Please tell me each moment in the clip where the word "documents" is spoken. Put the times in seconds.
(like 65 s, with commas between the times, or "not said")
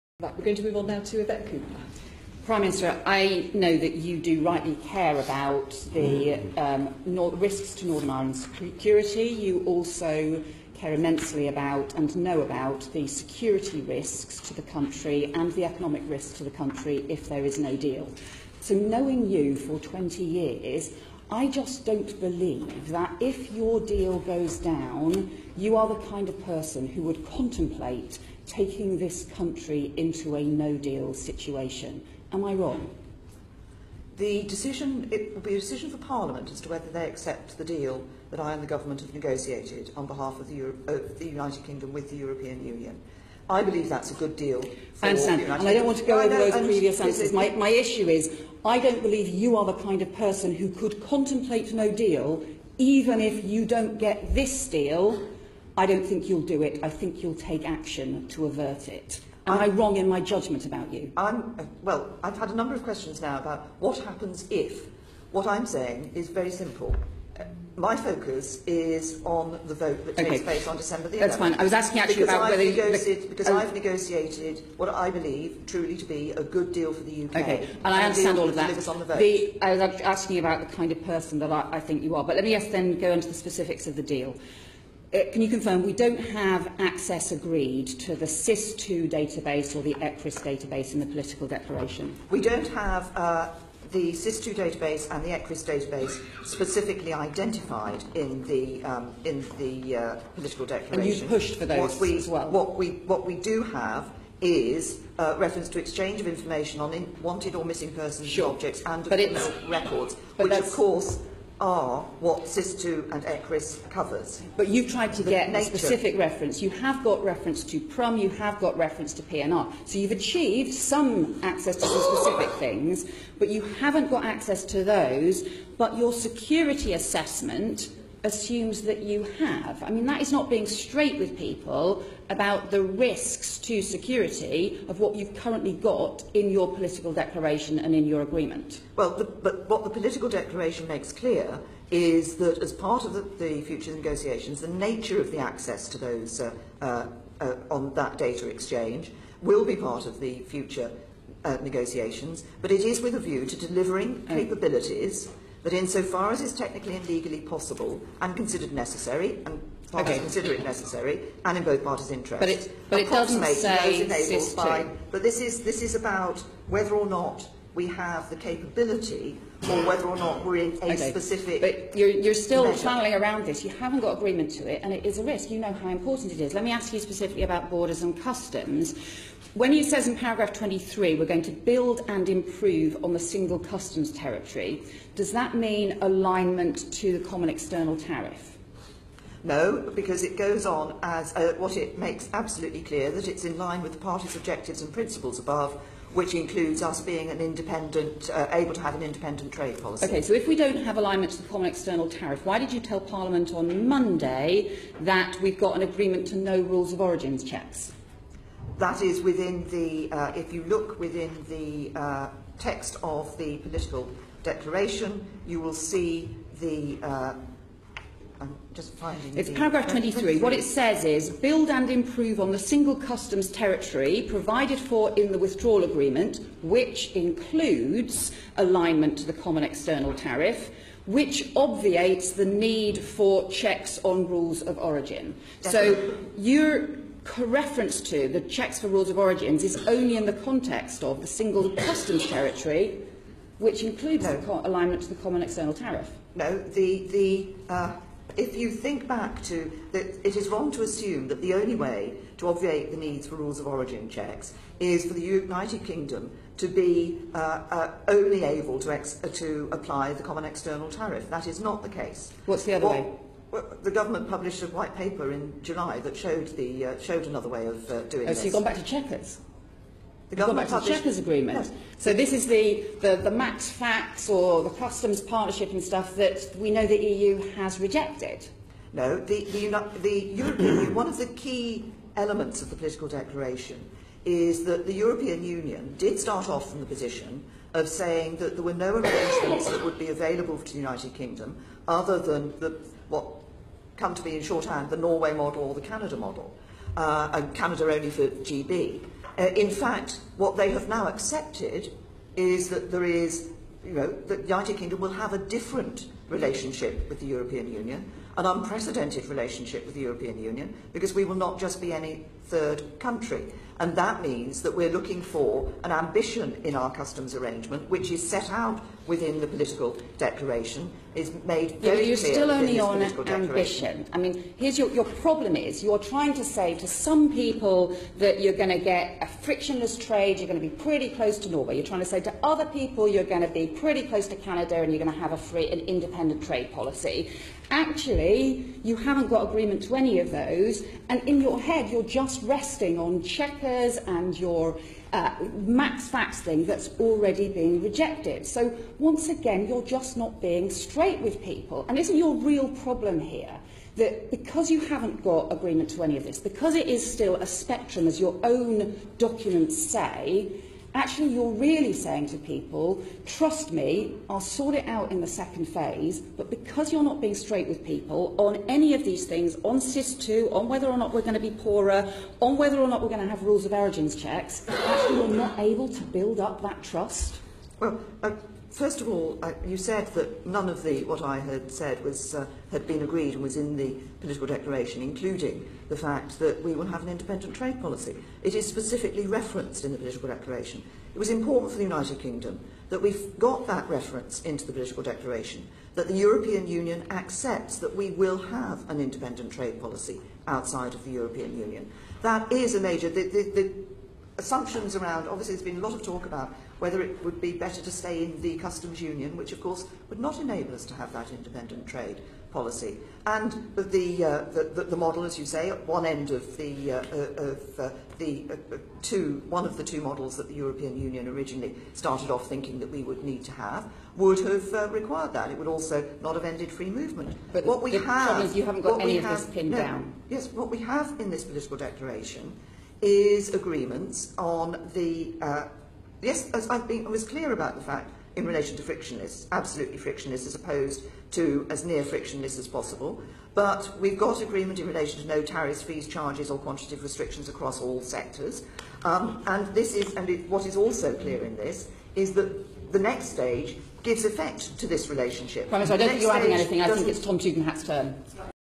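359 s.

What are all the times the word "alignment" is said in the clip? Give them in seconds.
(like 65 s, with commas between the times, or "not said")
185 s, 200 s, 228 s, 244 s.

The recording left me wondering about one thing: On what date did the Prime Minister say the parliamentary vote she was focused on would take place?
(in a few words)
December 11th.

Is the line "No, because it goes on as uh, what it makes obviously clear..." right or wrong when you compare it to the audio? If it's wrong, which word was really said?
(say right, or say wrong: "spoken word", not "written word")
wrong: "absolutely", not "obviously".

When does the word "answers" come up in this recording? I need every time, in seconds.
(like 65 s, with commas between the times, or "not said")
47 s.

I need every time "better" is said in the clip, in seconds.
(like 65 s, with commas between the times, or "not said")
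407 s.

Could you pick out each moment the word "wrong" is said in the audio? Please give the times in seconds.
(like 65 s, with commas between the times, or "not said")
32 s, 59 s, 250 s.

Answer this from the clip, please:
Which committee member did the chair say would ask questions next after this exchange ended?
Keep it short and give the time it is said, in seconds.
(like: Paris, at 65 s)
Tom Tugendhat, at 457 s.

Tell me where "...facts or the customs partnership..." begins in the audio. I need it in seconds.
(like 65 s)
273 s.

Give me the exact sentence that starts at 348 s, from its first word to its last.
So once again, you're just not being straight with people.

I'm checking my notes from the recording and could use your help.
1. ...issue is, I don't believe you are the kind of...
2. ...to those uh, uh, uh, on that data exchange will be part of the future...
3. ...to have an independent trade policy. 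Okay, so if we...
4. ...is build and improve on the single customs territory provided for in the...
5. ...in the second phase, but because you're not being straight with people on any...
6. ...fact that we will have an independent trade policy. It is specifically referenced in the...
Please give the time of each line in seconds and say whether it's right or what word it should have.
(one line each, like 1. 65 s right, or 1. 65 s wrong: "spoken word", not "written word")
1. 47 s right
2. 145 s right
3. 198 s right
4. 221 s right
5. 365 s right
6. 385 s right.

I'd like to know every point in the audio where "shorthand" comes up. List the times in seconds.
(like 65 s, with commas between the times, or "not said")
294 s.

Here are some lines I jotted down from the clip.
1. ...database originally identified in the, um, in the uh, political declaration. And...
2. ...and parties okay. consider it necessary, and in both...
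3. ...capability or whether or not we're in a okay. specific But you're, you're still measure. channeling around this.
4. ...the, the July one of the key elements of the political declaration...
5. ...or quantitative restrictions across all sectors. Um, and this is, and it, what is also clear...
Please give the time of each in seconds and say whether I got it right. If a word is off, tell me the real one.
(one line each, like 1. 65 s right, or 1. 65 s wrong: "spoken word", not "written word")
1. 95 s wrong: "specifically", not "originally"
2. 159 s right
3. 168 s right
4. 279 s wrong: "European", not "July"
5. 446 s right.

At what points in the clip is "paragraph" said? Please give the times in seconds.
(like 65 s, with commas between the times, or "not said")
180 s, 219 s.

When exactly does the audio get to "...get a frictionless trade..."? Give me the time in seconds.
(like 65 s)
328 s.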